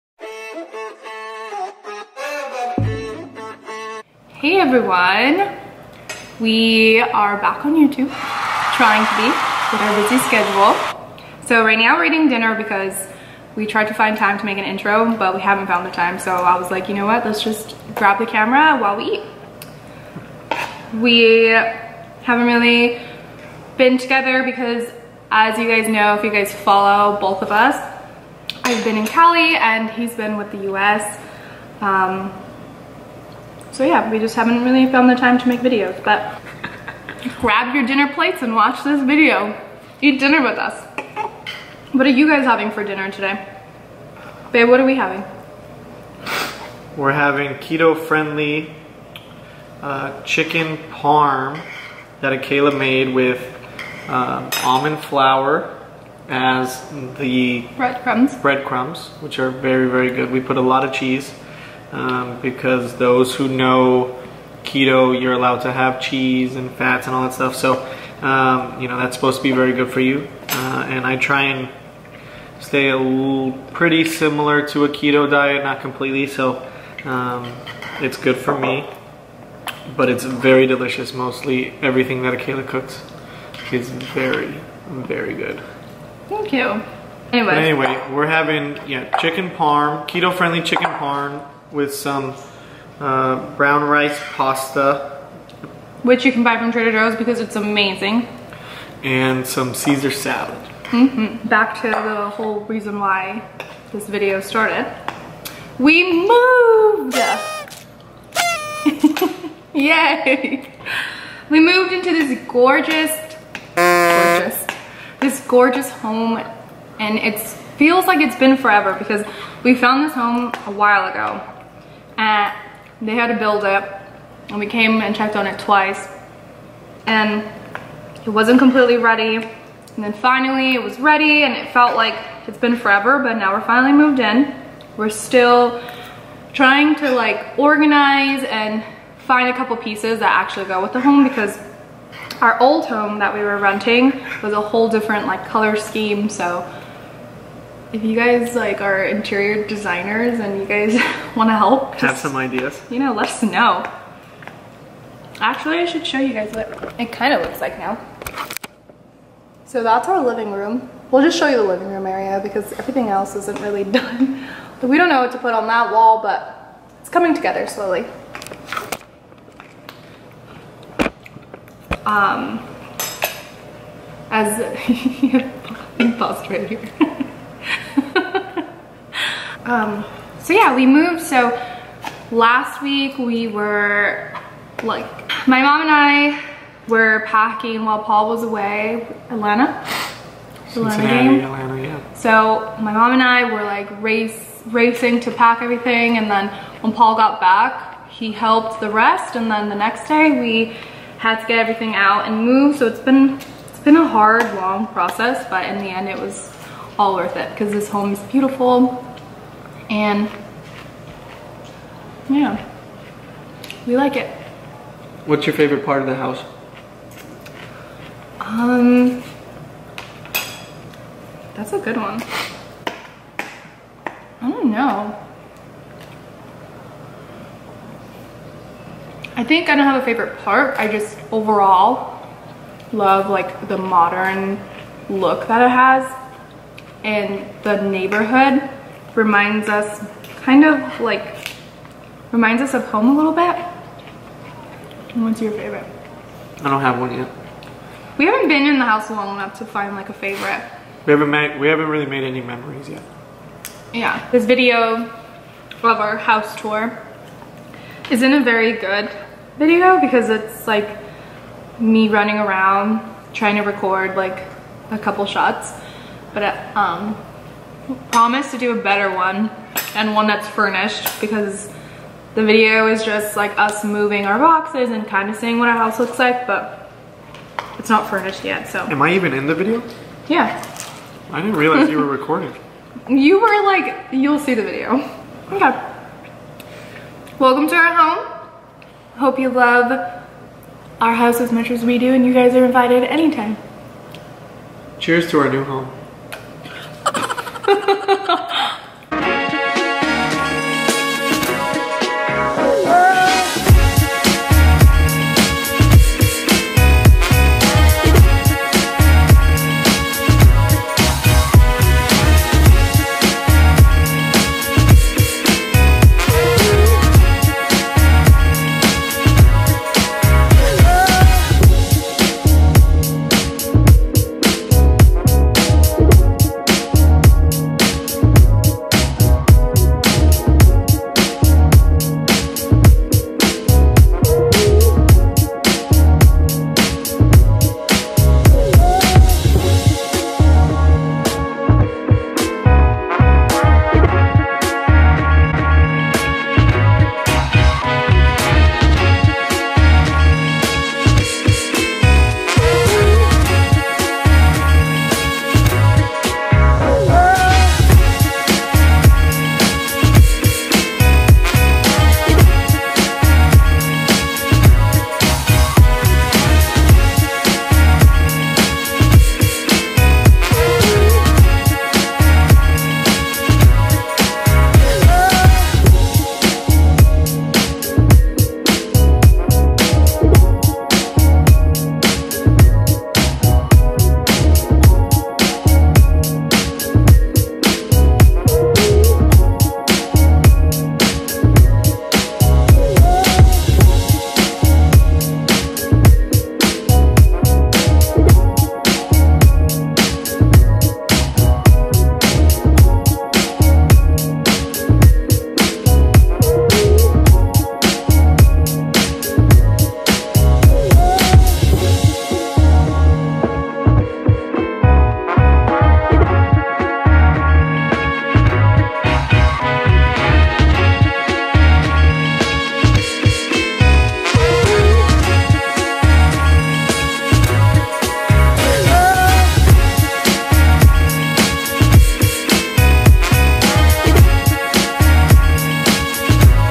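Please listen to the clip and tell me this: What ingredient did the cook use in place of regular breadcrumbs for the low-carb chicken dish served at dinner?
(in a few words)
almond flour.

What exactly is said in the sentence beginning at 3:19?
And then the next day we had to get everything out and move.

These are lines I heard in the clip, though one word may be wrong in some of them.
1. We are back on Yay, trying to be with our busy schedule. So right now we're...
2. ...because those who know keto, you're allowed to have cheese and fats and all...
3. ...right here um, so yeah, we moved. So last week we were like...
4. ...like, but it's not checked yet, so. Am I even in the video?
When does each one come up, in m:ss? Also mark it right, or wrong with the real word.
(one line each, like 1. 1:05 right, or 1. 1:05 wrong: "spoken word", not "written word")
1. 0:06 wrong: "YouTube", not "Yay"
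2. 1:02 right
3. 2:56 right
4. 4:36 wrong: "furnished", not "checked".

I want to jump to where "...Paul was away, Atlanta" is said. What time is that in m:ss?
3:08.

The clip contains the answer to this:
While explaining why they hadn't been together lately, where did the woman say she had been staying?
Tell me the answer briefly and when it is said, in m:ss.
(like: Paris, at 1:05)
Cali, at 0:29.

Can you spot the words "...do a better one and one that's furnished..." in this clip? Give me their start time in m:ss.
4:28.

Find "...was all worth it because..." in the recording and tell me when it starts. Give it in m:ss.
3:26.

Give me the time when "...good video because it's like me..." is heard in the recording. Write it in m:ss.
4:18.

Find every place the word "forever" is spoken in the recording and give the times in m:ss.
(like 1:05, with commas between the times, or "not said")
1:58, 2:12.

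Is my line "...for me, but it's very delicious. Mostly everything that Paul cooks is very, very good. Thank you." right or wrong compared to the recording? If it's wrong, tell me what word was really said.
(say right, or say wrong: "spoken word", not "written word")
wrong: "Akela", not "Paul".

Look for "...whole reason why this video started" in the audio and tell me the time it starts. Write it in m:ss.
1:42.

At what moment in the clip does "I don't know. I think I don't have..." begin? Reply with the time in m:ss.
3:44.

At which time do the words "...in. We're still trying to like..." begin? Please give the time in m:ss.
2:14.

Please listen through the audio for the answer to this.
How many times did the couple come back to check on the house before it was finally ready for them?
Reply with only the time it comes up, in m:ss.
2:05.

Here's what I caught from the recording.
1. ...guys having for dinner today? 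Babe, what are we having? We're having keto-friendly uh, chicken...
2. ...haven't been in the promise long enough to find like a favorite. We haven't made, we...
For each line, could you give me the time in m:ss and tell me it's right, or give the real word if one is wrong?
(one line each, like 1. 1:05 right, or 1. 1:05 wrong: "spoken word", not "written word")
1. 0:42 right
2. 4:08 wrong: "house", not "promise".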